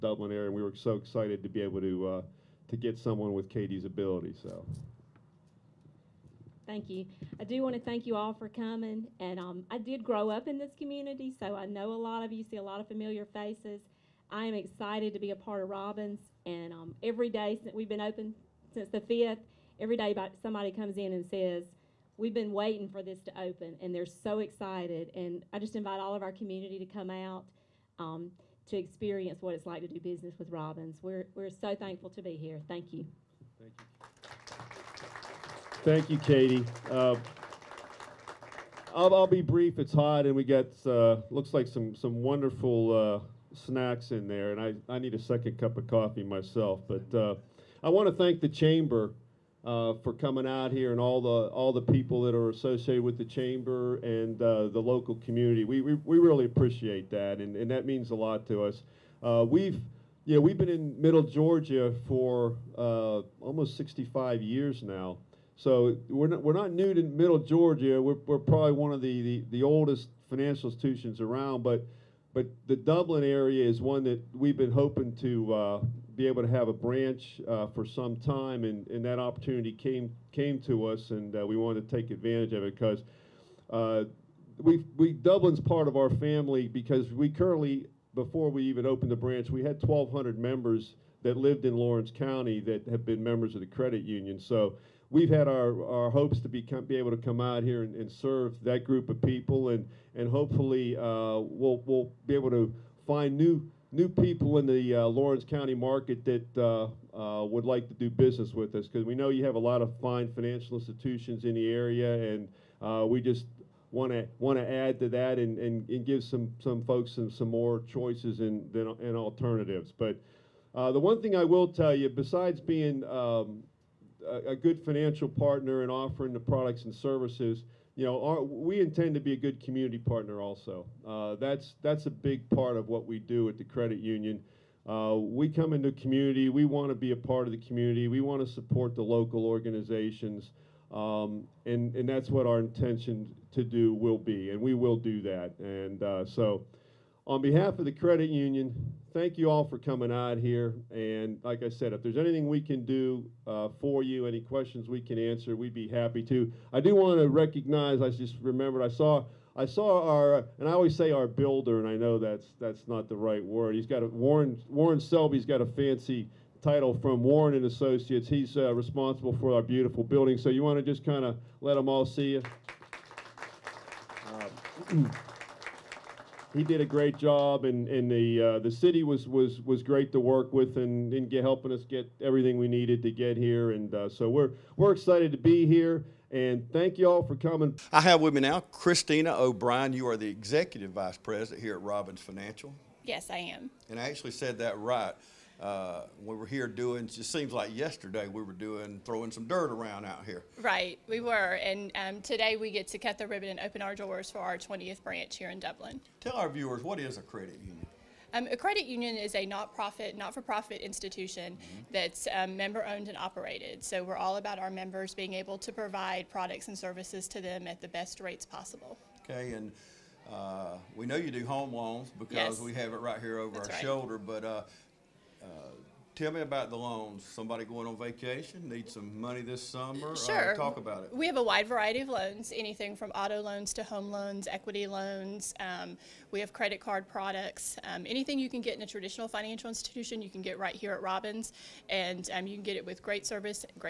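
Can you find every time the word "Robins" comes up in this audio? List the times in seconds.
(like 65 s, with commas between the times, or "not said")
15 s, 30 s, 191 s, 241 s.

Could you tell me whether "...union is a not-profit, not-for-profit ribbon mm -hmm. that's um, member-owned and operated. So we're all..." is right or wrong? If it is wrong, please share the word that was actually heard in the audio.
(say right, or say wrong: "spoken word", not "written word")
wrong: "institution", not "ribbon".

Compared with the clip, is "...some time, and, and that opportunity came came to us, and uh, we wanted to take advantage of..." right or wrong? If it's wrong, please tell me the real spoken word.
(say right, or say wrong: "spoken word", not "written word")
right.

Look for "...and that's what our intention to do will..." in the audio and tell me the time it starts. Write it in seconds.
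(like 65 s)
141 s.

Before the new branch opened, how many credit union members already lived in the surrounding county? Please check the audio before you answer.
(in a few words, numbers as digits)
1,200.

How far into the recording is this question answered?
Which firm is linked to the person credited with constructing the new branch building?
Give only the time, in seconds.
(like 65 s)
167 s.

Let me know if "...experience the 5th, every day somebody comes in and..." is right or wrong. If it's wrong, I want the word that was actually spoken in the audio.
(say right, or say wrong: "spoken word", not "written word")
wrong: "since", not "experience".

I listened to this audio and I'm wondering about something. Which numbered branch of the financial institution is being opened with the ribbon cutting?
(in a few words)
20th.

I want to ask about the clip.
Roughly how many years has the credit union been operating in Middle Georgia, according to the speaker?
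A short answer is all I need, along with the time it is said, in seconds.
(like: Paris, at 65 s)
65 years, at 63 s.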